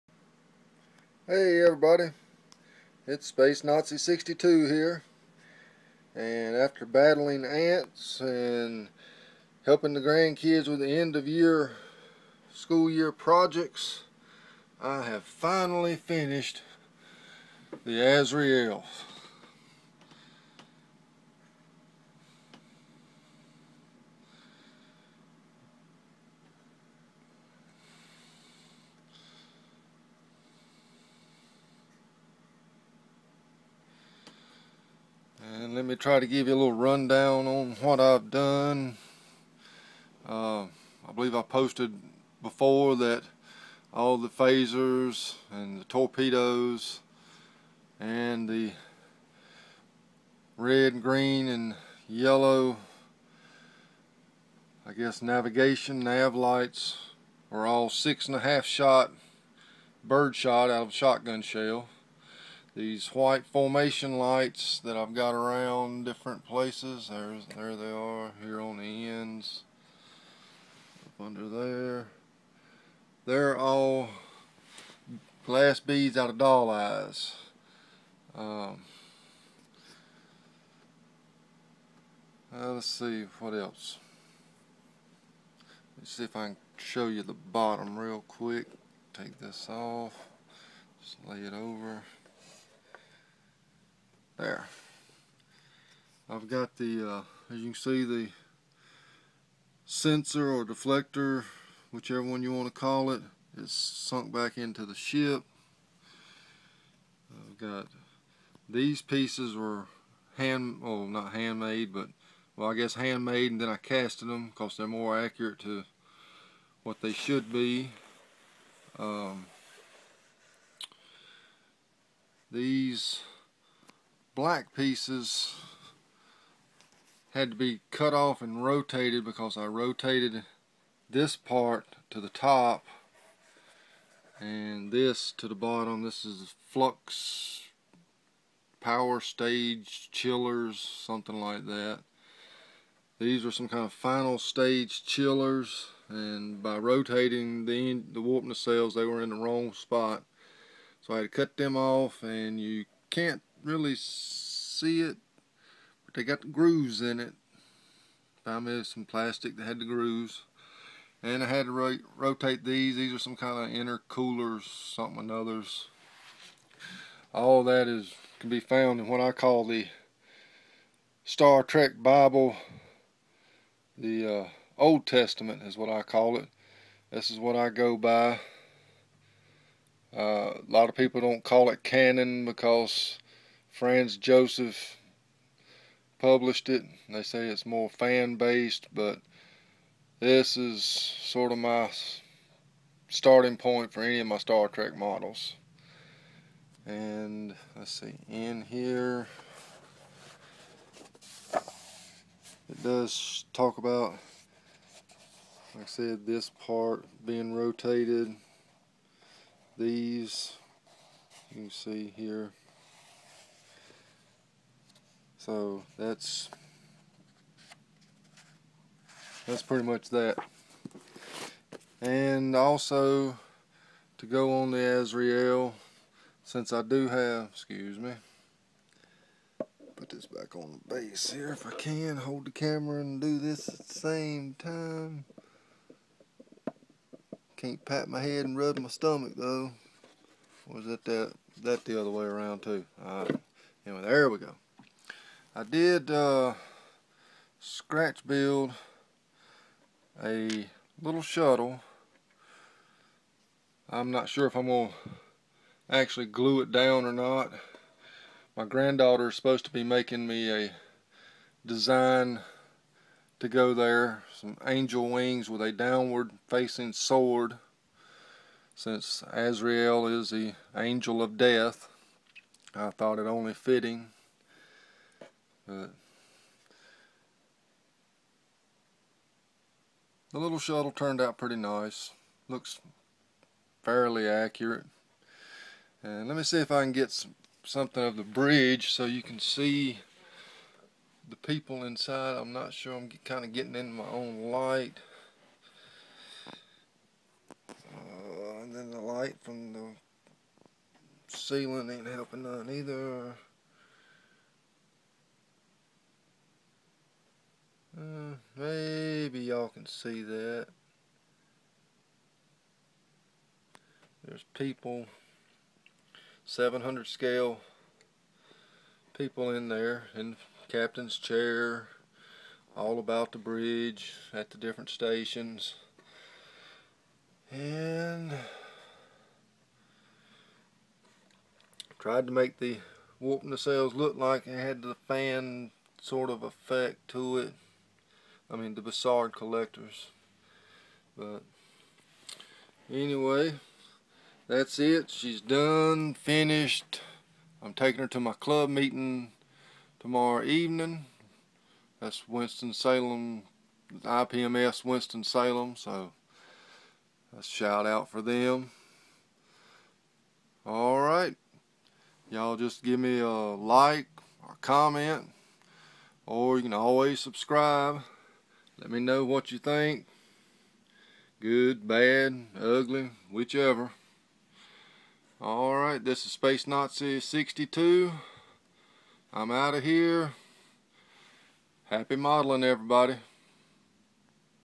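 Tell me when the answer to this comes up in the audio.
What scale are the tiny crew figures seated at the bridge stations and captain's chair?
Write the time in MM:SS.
05:16.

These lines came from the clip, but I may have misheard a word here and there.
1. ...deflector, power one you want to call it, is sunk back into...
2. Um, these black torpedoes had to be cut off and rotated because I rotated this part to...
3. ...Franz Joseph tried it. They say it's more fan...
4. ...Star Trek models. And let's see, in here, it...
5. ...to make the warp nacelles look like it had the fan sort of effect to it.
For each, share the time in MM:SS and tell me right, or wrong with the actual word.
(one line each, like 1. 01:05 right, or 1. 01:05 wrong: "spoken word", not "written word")
1. 01:40 wrong: "whichever", not "power"
2. 01:58 wrong: "pieces", not "torpedoes"
3. 03:03 wrong: "published", not "tried"
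4. 03:14 right
5. 05:32 right.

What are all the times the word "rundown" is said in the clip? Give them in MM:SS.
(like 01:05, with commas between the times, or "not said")
00:36.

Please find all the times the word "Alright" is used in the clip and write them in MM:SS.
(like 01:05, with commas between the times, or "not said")
04:03, 06:00, 06:15.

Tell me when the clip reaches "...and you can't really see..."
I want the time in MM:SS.
02:32.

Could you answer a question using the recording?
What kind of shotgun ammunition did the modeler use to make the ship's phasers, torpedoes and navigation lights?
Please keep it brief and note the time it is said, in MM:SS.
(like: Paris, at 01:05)
six and a half shot bird shot, at 00:57.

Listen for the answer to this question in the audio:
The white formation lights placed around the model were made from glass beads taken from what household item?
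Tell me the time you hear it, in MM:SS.
01:16.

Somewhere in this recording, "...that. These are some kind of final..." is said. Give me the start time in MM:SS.
02:21.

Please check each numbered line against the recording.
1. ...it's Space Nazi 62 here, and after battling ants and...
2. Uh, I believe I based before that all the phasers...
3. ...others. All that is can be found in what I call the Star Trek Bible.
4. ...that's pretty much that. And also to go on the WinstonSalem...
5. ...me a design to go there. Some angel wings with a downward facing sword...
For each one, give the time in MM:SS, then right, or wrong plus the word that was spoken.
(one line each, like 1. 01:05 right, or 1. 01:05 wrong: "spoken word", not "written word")
1. 00:03 right
2. 00:40 wrong: "posted", not "based"
3. 02:45 right
4. 03:39 wrong: "Azrael", not "WinstonSalem"
5. 04:20 right.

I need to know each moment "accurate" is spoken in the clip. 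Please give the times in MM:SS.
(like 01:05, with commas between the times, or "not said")
01:55, 04:44.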